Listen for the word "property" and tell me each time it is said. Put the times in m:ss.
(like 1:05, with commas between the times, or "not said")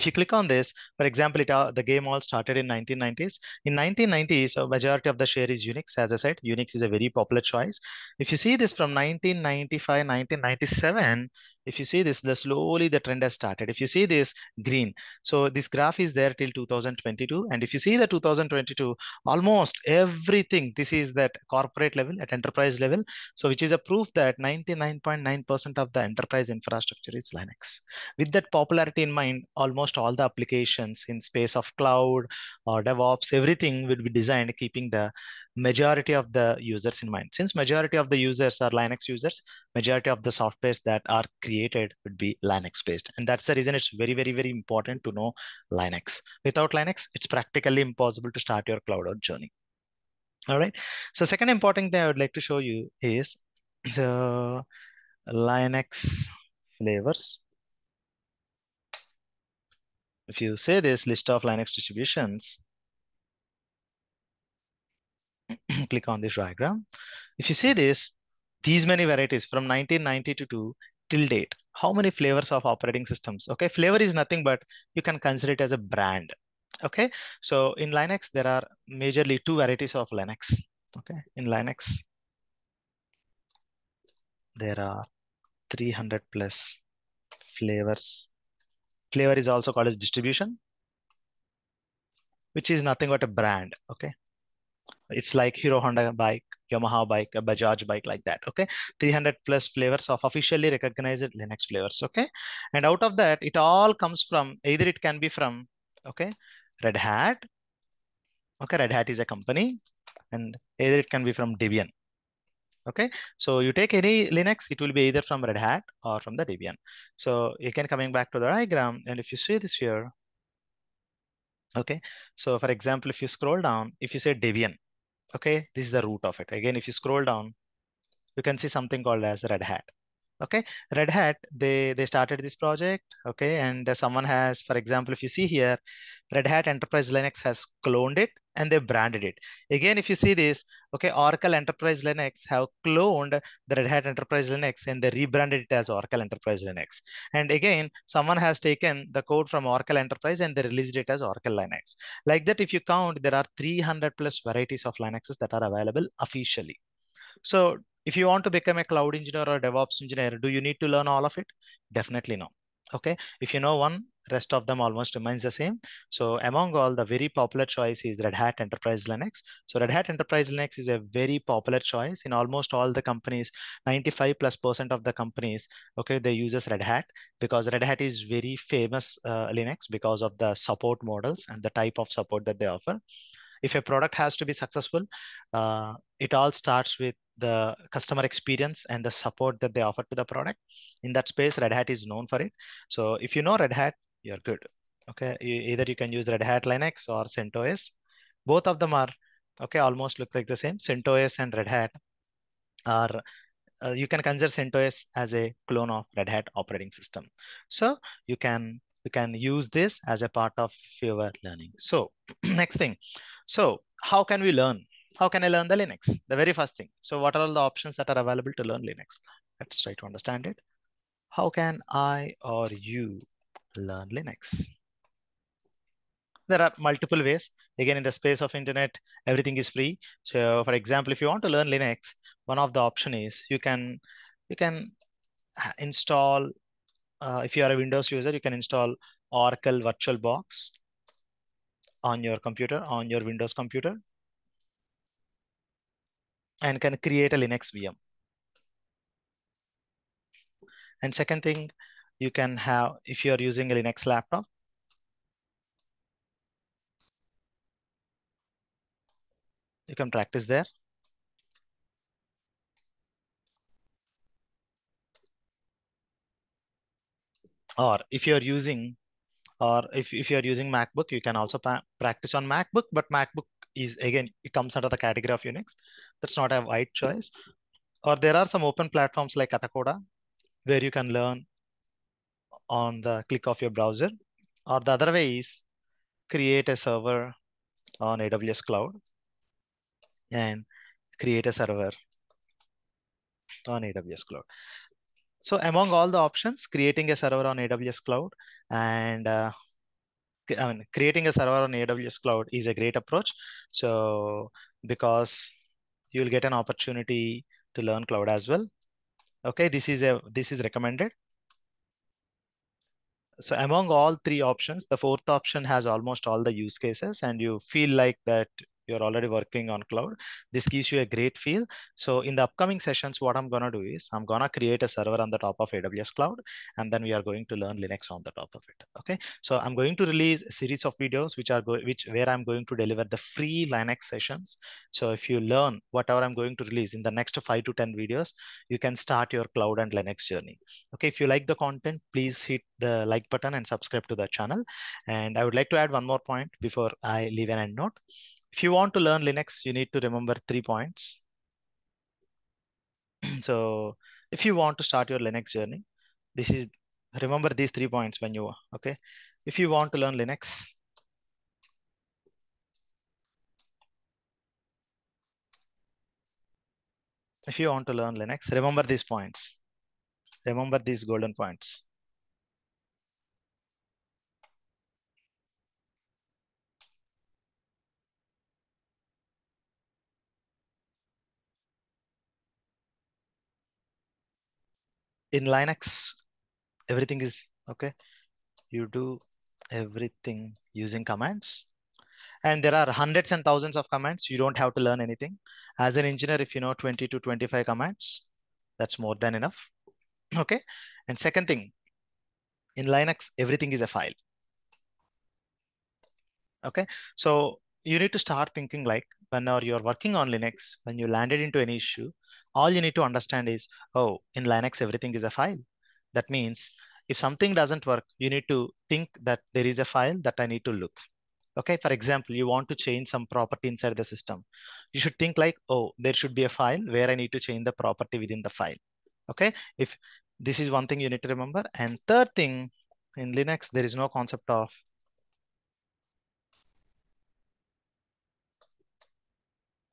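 7:03, 7:07.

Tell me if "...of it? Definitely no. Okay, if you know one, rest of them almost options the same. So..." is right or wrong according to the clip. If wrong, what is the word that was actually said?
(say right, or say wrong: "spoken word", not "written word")
wrong: "remains", not "options".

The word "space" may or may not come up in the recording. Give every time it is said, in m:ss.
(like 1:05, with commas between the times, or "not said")
0:31, 3:11, 3:48.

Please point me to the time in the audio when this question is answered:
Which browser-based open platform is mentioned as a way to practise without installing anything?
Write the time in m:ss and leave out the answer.
4:39.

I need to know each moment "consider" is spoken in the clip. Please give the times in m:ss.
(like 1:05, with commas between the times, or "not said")
1:15, 3:24.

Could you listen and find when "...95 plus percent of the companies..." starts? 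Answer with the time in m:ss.
2:53.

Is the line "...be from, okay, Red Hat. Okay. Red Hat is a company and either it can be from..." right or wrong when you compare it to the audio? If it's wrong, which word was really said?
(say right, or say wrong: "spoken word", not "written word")
right.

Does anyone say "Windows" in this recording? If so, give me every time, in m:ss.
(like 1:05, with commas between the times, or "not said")
3:57, 4:03.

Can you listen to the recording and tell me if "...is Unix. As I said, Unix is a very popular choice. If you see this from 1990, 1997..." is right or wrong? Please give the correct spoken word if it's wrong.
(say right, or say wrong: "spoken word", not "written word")
wrong: "1995", not "1990".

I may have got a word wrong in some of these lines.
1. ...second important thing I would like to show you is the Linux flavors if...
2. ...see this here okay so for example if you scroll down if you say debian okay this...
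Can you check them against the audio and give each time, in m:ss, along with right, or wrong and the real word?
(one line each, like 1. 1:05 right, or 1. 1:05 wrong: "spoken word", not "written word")
1. 0:51 right
2. 1:59 right.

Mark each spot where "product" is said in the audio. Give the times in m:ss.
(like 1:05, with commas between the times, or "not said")
3:03, 3:10.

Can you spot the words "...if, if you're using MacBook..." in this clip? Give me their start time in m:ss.
4:29.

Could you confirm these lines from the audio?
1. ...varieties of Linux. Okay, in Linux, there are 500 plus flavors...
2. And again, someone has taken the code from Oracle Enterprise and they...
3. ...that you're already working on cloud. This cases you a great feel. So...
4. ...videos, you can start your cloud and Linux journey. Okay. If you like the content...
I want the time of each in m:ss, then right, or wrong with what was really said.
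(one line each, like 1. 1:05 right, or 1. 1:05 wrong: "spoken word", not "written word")
1. 1:19 wrong: "300", not "500"
2. 2:27 right
3. 5:18 wrong: "gives", not "cases"
4. 5:37 right.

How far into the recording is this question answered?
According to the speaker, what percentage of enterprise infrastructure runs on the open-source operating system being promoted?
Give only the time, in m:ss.
0:24.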